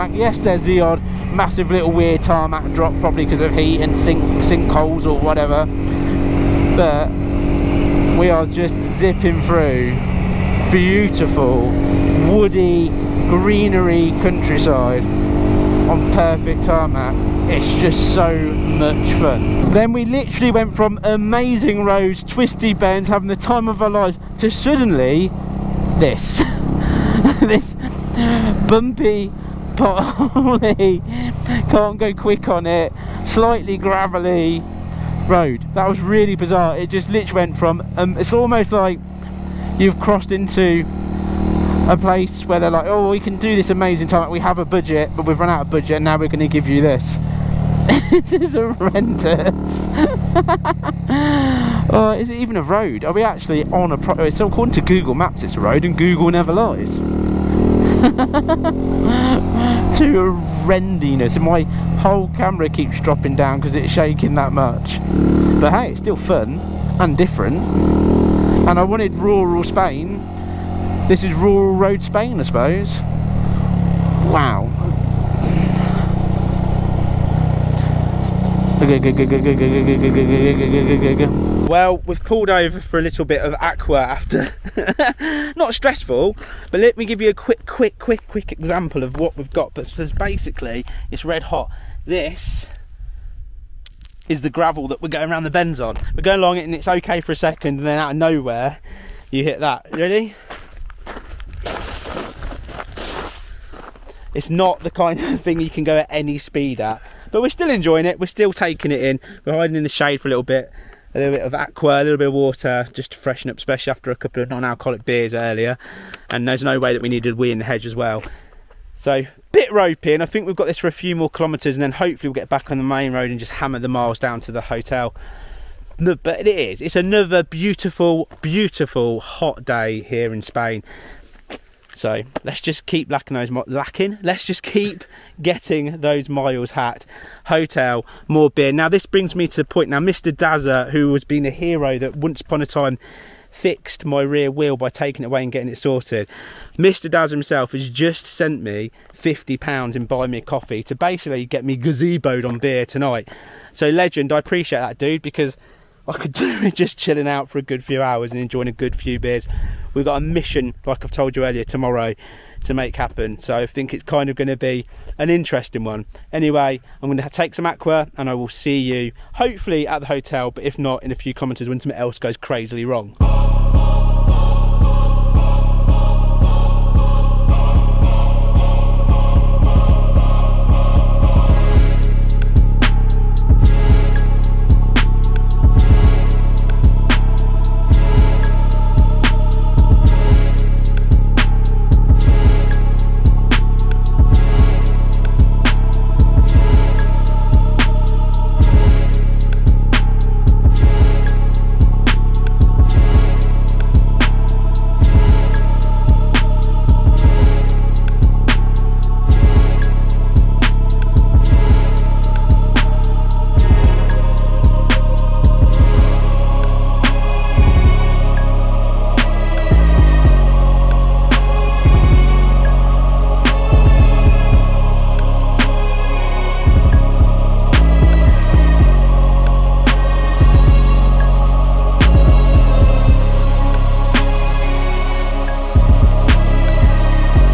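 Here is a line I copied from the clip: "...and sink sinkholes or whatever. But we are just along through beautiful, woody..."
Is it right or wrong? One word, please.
wrong.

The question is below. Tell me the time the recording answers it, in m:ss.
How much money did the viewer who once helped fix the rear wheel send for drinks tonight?
2:29.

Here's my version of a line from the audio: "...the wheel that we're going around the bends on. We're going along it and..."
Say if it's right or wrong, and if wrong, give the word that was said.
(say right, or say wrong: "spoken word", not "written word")
wrong: "gravel", not "wheel".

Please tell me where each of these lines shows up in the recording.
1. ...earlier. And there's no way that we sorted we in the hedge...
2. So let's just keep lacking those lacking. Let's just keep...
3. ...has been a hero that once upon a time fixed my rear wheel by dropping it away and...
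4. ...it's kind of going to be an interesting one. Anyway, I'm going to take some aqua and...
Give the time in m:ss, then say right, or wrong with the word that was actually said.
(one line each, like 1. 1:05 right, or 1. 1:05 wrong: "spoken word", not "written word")
1. 1:55 wrong: "needed", not "sorted"
2. 2:11 right
3. 2:21 wrong: "taking", not "dropping"
4. 2:43 right.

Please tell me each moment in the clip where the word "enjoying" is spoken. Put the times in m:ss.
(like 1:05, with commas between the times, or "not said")
1:47, 2:38.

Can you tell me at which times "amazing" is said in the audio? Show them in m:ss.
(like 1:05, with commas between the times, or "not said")
0:21, 0:43.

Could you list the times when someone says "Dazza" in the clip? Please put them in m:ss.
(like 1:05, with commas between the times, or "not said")
2:20, 2:27.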